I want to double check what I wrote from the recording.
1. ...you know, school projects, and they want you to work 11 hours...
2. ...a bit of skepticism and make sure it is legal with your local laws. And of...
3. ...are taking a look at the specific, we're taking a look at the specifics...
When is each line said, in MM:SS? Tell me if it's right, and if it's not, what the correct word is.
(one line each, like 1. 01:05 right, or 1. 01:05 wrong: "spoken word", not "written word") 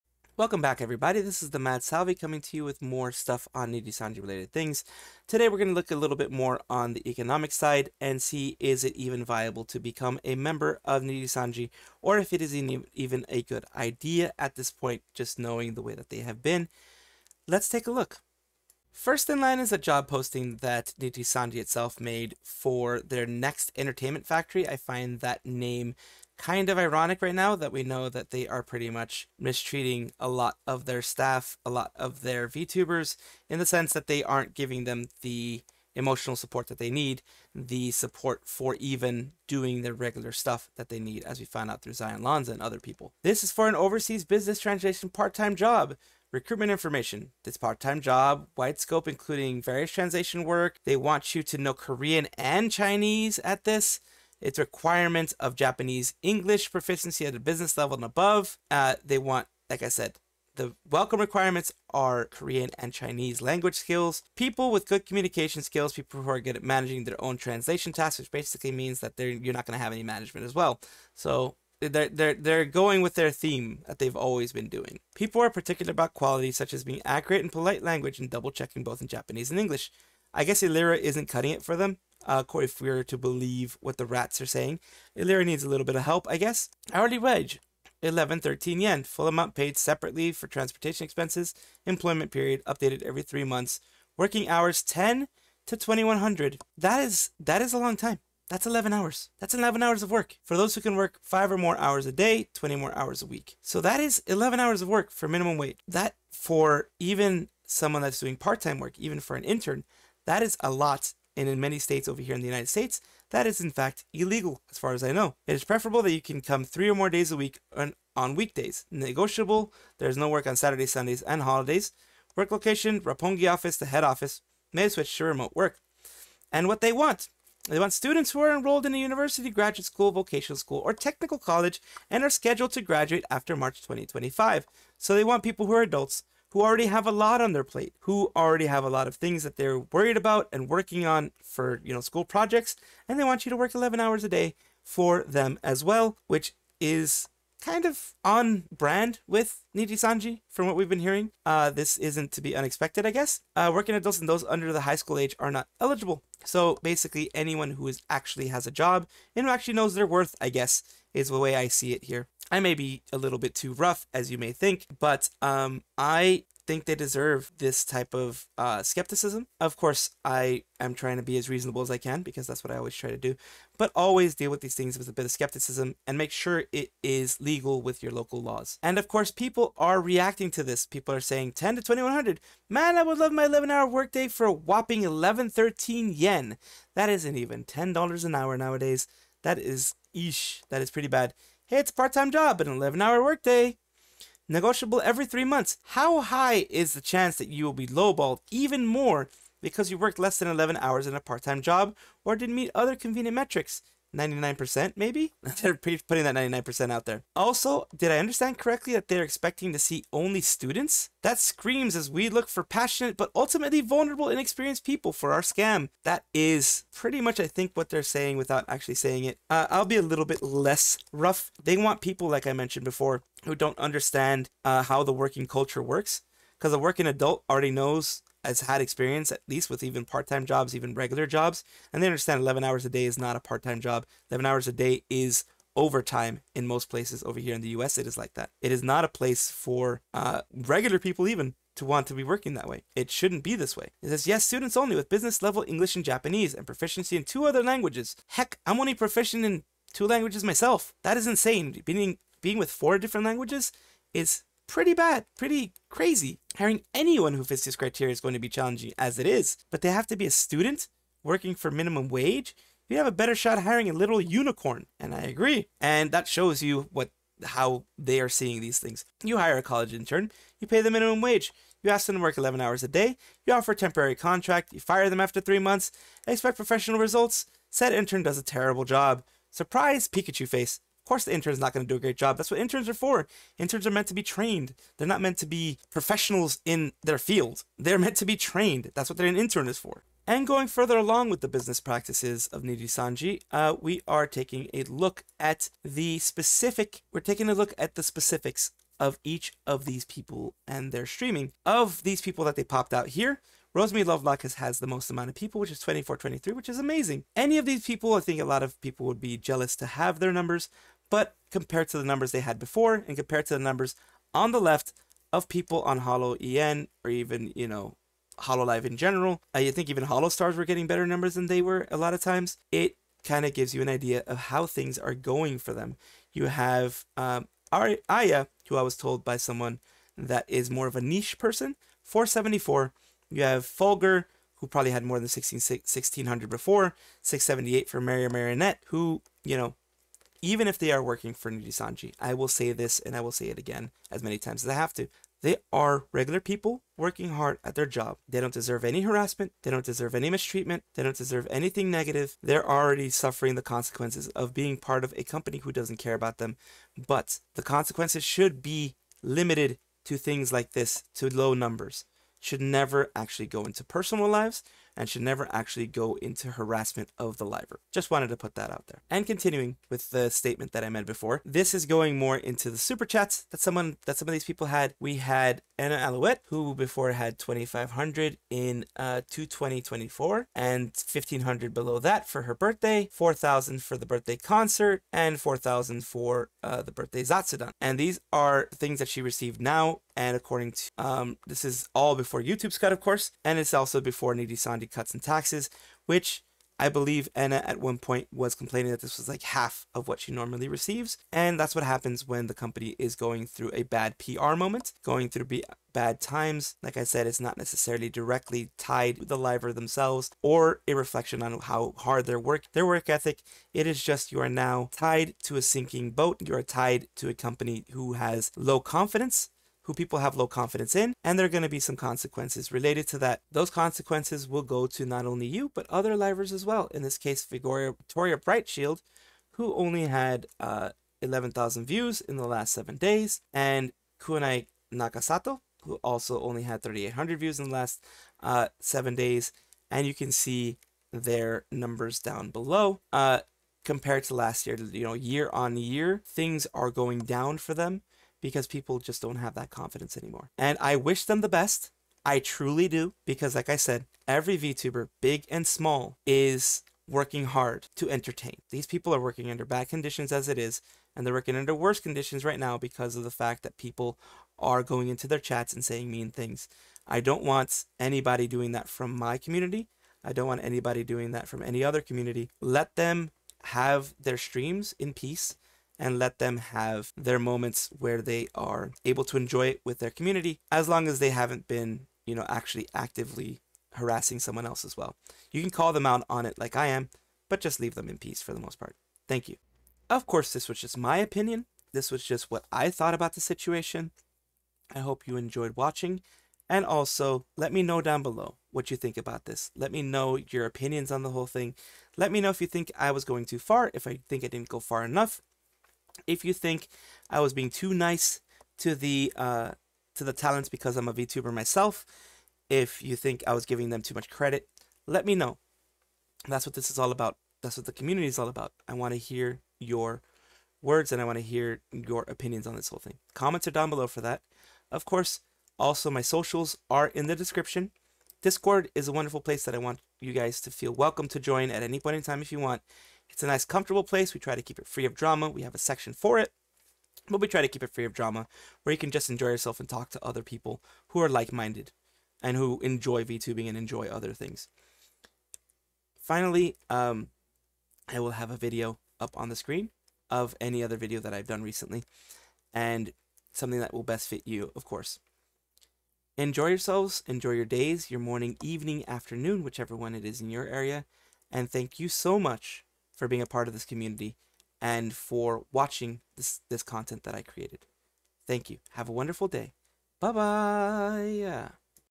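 1. 02:21 right
2. 02:55 right
3. 04:54 right.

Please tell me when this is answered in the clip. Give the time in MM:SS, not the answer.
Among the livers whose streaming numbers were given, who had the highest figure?
05:03.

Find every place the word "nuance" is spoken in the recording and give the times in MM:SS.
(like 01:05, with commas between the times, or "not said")
not said.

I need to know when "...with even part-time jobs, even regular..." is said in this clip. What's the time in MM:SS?
03:49.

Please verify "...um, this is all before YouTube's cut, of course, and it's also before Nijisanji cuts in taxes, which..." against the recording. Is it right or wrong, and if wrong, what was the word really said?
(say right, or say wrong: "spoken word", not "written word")
right.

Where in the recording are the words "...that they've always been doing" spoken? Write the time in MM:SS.
01:13.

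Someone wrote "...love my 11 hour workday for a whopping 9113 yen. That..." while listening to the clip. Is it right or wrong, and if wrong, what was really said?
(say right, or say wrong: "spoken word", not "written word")
wrong: "1113", not "9113".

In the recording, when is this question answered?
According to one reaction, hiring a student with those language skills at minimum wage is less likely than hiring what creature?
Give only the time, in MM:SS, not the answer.
04:23.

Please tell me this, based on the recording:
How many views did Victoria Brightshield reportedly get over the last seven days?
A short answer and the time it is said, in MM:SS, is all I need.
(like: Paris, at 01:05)
11,000, at 07:11.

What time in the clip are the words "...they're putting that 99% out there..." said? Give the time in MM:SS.
03:25.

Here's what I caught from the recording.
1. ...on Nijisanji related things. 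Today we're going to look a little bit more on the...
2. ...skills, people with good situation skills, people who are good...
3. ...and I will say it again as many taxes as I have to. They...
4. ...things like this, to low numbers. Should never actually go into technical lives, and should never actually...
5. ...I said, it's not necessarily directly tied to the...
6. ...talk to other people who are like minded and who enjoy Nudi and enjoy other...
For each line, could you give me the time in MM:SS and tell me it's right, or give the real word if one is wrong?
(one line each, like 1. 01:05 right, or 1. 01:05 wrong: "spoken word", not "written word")
1. 00:03 right
2. 01:03 wrong: "communication", not "situation"
3. 05:42 wrong: "times", not "taxes"
4. 06:00 wrong: "personal", not "technical"
5. 06:46 right
6. 08:59 wrong: "VTubing", not "Nudi".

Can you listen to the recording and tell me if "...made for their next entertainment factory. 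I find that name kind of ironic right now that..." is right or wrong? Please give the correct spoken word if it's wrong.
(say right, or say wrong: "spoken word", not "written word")
right.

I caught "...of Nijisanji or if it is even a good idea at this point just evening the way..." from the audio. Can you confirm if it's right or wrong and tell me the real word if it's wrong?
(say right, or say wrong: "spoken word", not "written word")
wrong: "knowing", not "evening".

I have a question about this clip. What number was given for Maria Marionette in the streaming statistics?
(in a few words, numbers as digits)
678.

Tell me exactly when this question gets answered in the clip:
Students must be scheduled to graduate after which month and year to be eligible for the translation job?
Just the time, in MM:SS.
02:13.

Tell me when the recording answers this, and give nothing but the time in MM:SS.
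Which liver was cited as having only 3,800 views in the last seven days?
07:14.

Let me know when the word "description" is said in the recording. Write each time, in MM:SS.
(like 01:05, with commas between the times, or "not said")
08:47.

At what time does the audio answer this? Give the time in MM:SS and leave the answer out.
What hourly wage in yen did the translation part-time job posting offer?
01:28.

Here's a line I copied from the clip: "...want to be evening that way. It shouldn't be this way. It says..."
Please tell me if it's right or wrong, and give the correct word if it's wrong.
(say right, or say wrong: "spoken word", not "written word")
wrong: "working", not "evening".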